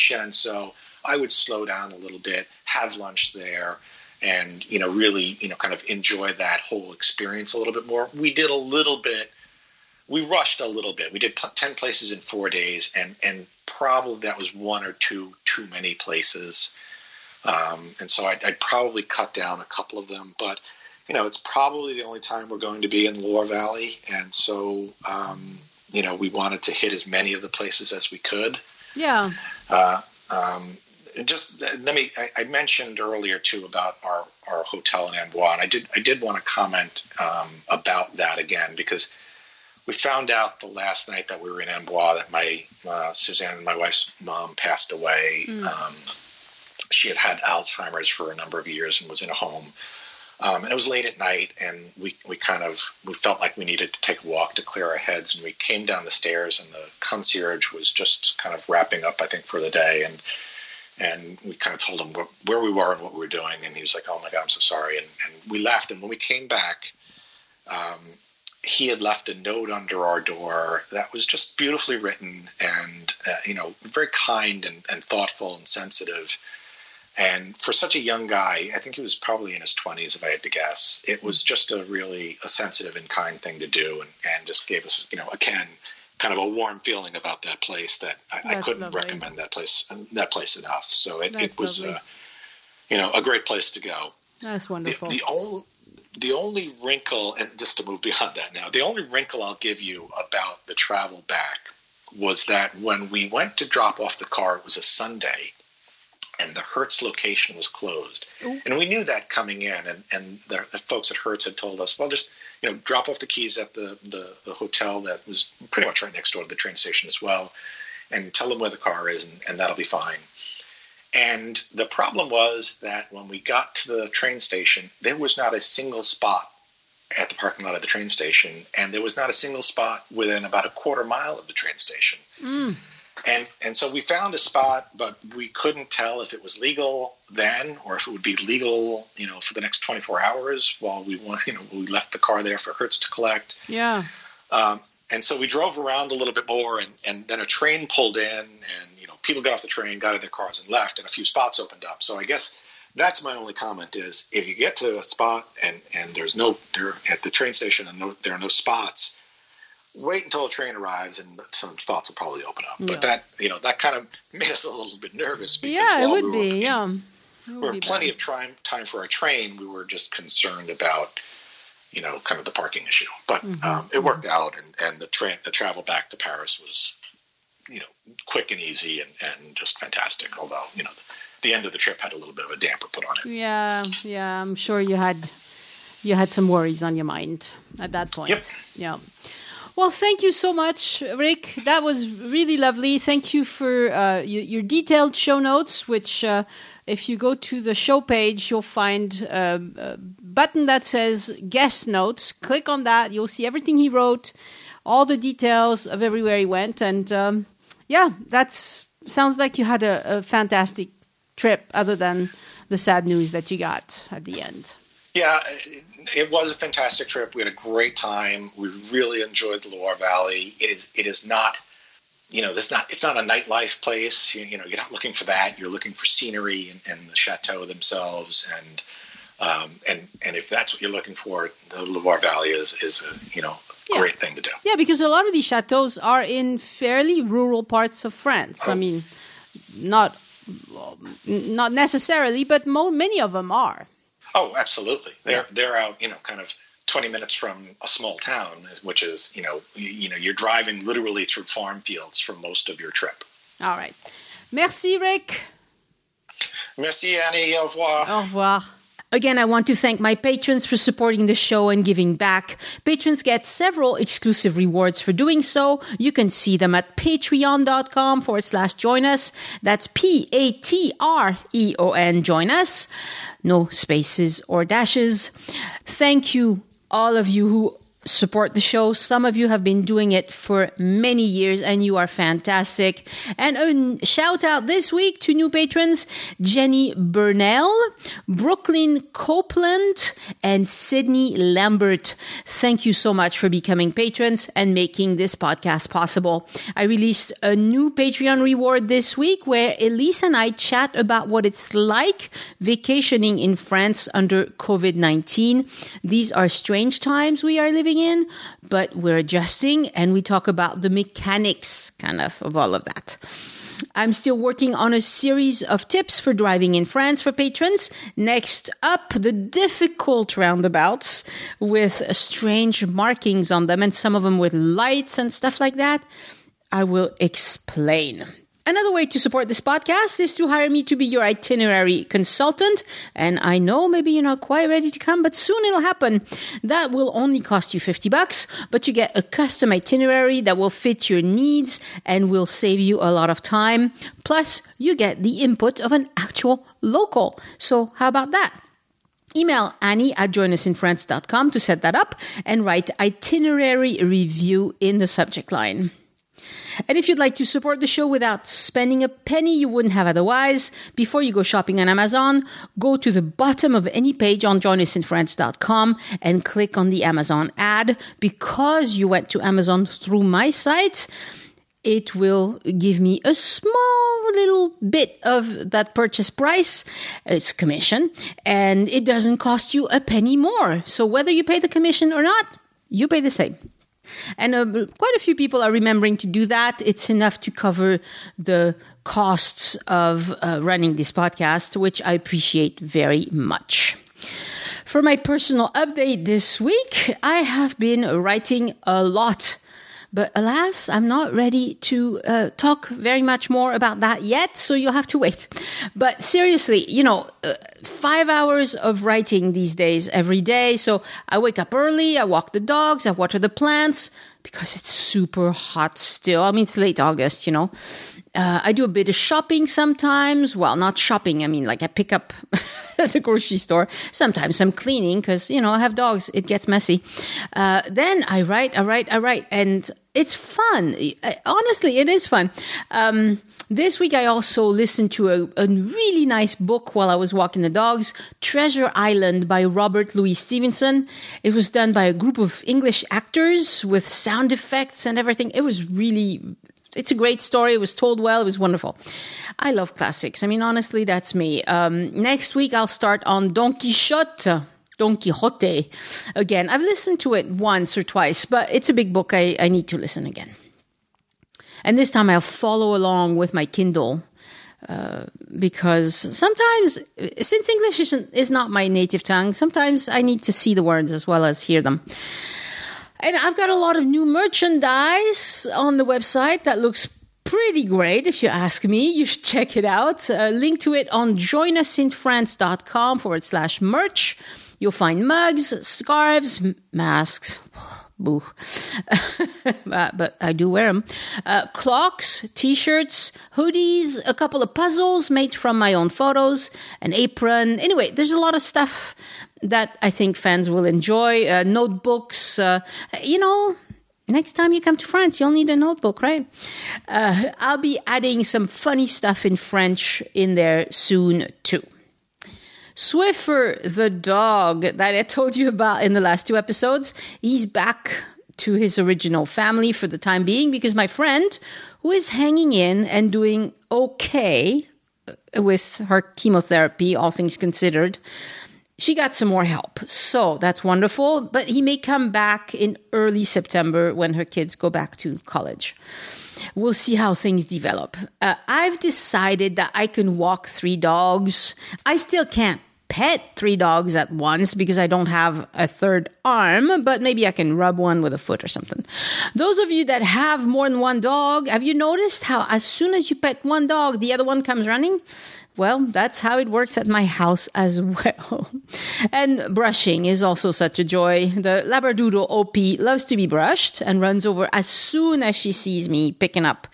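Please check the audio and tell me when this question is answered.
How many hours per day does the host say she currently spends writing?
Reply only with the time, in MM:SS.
06:47.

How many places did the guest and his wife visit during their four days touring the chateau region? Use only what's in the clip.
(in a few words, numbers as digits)
10.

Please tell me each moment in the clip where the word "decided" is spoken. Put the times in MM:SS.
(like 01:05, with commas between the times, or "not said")
08:58.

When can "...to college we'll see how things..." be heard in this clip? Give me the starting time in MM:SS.
08:55.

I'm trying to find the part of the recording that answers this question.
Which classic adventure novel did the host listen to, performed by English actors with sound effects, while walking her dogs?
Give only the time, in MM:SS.
07:18.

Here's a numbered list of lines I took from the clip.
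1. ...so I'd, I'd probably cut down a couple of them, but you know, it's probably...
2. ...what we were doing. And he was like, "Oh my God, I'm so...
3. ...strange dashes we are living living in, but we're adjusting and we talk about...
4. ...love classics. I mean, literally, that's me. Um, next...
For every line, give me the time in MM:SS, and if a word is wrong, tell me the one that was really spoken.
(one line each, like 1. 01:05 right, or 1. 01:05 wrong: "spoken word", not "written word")
1. 00:18 right
2. 01:03 right
3. 05:06 wrong: "times", not "dashes"
4. 07:29 wrong: "honestly", not "literally".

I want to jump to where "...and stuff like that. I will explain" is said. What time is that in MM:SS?
05:25.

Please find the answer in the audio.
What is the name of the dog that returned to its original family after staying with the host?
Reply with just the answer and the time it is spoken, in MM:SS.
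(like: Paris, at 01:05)
Swiffer, at 08:32.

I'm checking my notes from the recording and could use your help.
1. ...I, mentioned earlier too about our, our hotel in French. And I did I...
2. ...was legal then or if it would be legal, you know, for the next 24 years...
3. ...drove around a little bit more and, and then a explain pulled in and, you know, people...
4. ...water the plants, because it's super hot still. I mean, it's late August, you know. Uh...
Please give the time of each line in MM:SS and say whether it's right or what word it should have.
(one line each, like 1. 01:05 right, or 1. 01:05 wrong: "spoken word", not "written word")
1. 00:32 wrong: "Amboise", not "French"
2. 02:16 wrong: "hours", not "years"
3. 02:25 wrong: "train", not "explain"
4. 06:53 right.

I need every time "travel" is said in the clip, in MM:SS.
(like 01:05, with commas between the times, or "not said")
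01:40, 02:55.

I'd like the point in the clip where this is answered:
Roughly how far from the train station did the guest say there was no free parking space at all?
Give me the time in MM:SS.
02:10.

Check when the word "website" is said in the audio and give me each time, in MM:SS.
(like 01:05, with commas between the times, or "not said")
07:56.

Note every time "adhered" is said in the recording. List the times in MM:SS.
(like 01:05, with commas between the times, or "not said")
not said.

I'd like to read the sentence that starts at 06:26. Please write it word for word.
It's enough to cover the costs of uh, running this podcast, which I appreciate very much.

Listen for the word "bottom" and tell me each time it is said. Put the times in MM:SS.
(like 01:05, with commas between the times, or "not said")
06:03.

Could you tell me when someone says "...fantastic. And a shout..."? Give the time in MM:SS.
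04:42.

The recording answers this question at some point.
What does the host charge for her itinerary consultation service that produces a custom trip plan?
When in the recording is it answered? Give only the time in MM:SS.
05:37.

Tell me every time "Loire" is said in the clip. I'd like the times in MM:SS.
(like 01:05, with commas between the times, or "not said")
00:23, 03:39, 03:51.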